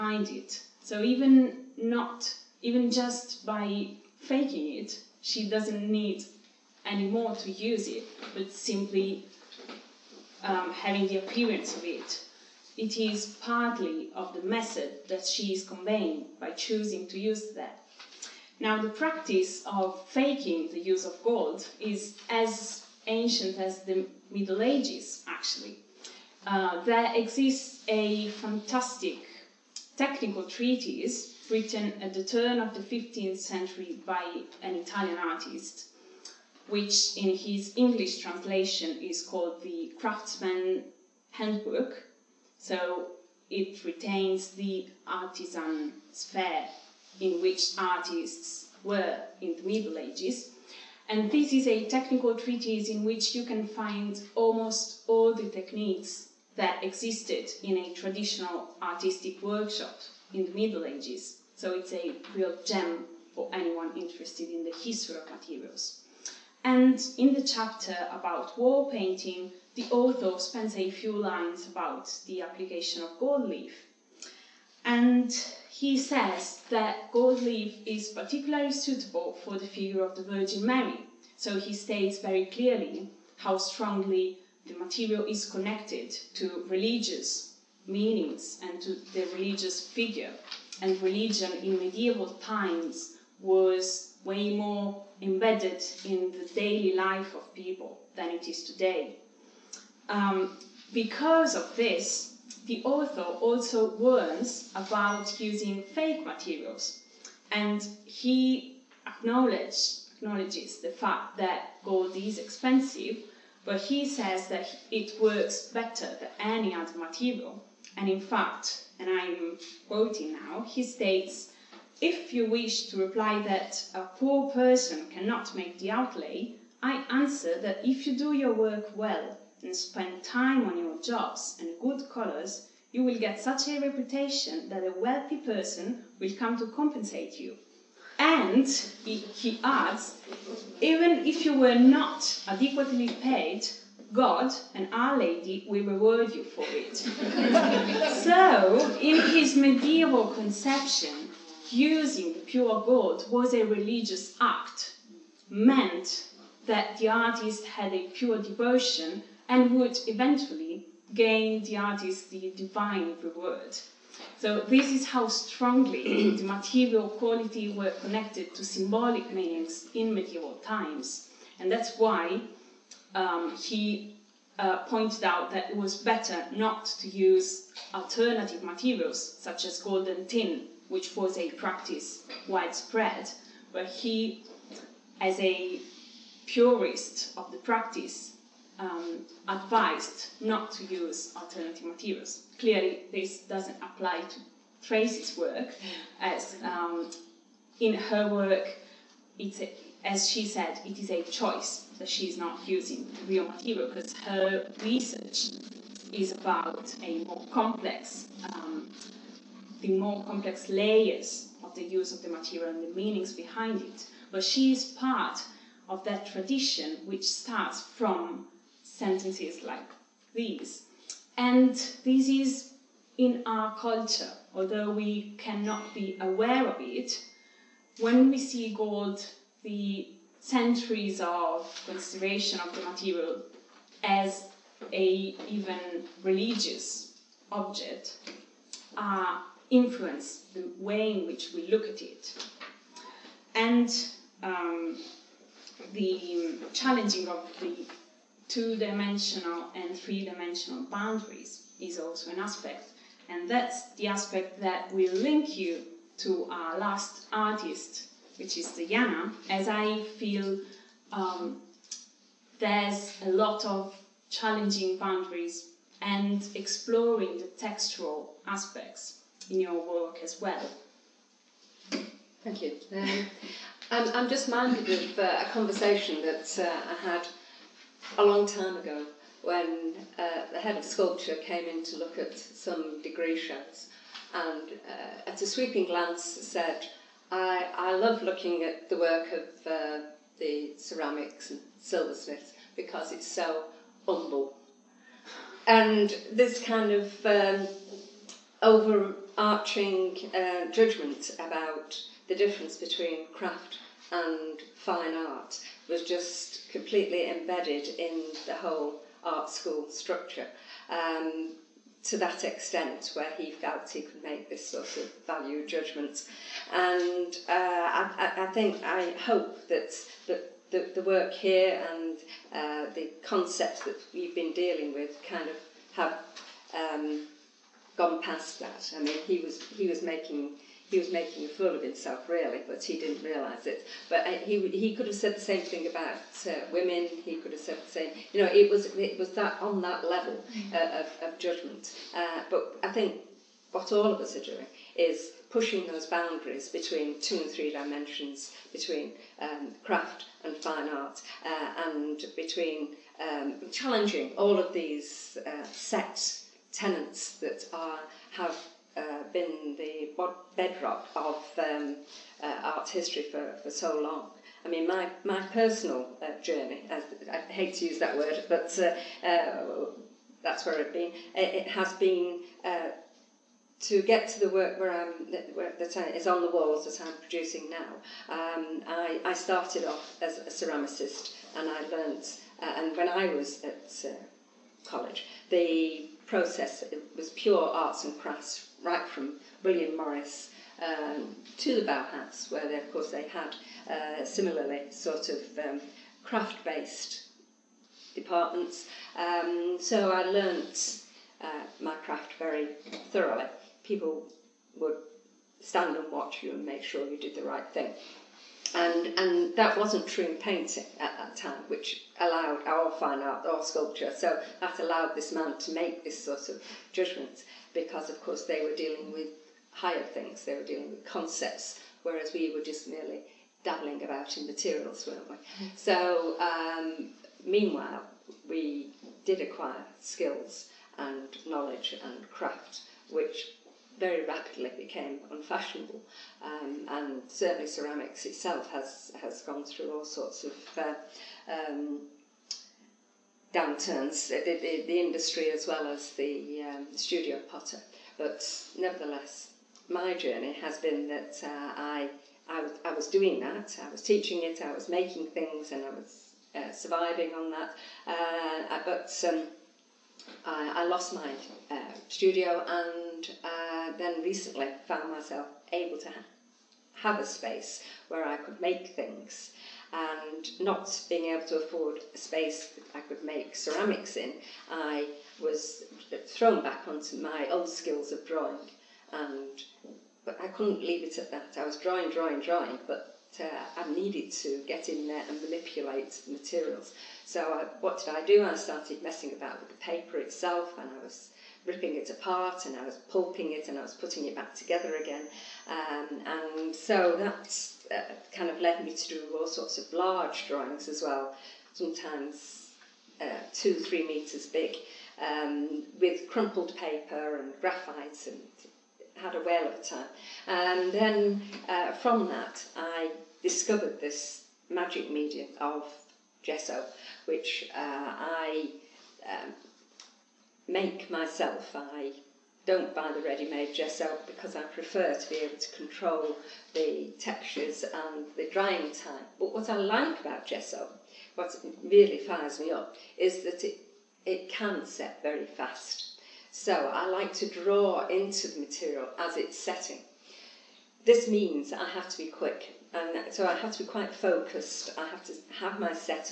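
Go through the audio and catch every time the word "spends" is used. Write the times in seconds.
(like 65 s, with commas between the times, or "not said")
70 s, 129 s.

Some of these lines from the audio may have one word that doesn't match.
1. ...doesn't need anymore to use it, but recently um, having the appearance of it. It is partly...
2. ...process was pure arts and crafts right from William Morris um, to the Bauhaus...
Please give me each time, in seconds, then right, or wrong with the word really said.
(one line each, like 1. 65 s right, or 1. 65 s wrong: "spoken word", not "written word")
1. 5 s wrong: "simply", not "recently"
2. 386 s right.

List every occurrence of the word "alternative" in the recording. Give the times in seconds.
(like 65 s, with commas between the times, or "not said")
177 s, 191 s.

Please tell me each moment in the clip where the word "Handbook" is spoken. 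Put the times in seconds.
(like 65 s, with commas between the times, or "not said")
41 s.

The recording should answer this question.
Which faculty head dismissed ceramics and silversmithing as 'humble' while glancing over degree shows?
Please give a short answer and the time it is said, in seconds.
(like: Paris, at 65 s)
Head of sculpture, at 280 s.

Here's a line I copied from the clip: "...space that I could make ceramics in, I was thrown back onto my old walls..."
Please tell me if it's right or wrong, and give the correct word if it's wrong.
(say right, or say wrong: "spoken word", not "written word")
wrong: "skills", not "walls".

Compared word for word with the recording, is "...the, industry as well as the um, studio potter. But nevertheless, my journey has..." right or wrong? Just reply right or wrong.
right.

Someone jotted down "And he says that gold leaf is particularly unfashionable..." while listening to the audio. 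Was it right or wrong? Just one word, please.
wrong.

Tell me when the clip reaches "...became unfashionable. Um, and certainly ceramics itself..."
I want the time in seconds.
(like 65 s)
434 s.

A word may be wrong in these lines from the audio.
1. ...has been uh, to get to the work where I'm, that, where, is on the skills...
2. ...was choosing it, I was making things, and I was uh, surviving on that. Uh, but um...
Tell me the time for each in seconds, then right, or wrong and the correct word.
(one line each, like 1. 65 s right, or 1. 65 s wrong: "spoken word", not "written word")
1. 371 s wrong: "walls", not "skills"
2. 453 s wrong: "teaching", not "choosing".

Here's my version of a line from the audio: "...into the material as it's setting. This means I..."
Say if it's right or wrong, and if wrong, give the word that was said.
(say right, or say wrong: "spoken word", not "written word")
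right.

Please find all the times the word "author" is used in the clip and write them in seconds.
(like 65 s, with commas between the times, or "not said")
69 s, 102 s.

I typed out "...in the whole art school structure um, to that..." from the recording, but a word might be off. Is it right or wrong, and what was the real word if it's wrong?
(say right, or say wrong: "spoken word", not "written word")
right.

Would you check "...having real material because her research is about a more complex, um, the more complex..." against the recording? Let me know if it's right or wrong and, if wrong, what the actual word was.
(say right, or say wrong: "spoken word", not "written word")
wrong: "using", not "having".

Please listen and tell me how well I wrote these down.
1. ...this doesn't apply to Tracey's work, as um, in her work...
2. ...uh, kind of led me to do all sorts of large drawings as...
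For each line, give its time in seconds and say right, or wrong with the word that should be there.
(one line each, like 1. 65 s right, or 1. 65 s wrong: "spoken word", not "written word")
1. 193 s right
2. 497 s right.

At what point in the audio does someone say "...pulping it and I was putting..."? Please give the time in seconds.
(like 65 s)
493 s.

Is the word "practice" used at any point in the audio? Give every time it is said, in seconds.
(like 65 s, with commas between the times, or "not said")
18 s, 181 s, 187 s.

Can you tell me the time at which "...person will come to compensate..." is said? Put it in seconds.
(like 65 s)
135 s.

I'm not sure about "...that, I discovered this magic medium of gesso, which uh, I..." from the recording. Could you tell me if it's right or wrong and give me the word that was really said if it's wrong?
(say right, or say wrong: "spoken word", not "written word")
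right.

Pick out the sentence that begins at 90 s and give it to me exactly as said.
And religion in medieval times was way more embedded in the daily life of people than it is today.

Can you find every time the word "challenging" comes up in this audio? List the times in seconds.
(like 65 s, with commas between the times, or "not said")
246 s, 264 s, 353 s.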